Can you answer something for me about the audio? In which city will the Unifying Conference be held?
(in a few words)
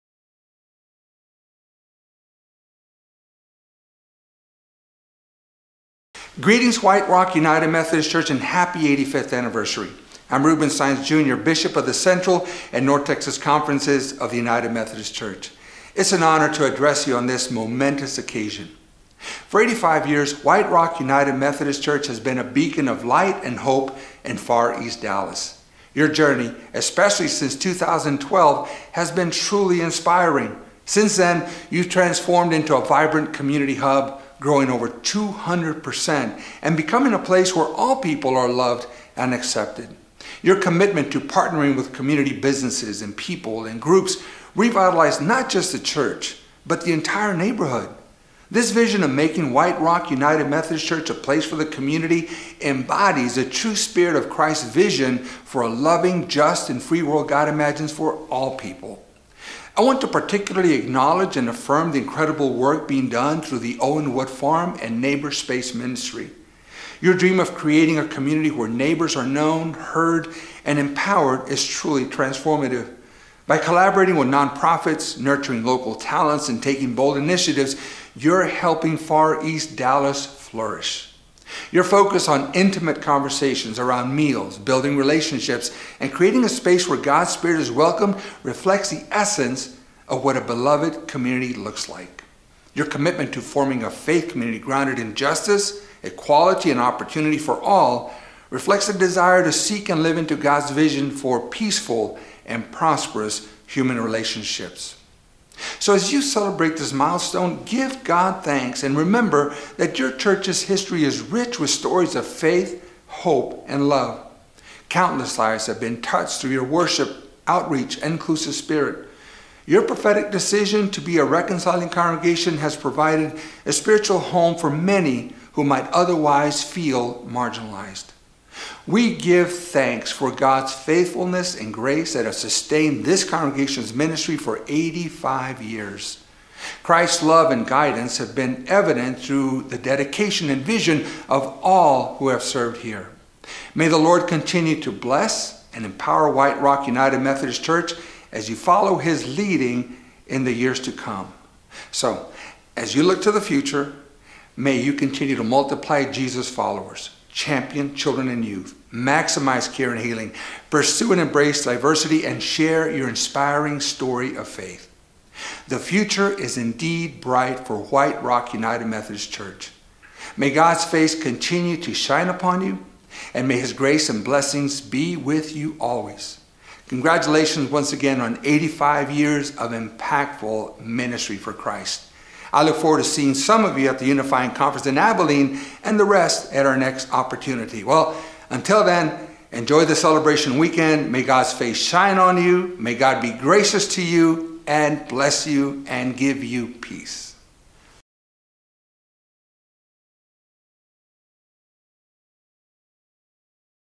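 Abilene.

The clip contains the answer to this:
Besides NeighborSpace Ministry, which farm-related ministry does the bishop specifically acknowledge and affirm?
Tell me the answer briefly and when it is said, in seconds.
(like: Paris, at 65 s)
Owenwood Farm, at 63 s.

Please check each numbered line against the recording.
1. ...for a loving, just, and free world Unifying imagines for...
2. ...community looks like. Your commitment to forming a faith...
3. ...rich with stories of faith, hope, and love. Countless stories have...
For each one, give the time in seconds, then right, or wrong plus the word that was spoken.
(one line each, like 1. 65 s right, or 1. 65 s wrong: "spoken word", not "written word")
1. 55 s wrong: "God", not "Unifying"
2. 91 s right
3. 111 s wrong: "lives", not "stories".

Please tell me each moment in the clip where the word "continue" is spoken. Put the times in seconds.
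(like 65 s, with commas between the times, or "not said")
144 s, 154 s, 171 s.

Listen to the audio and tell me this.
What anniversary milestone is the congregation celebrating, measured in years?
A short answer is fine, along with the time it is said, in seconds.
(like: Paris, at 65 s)
85, at 9 s.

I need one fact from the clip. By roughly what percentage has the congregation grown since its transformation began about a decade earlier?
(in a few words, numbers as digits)
200%.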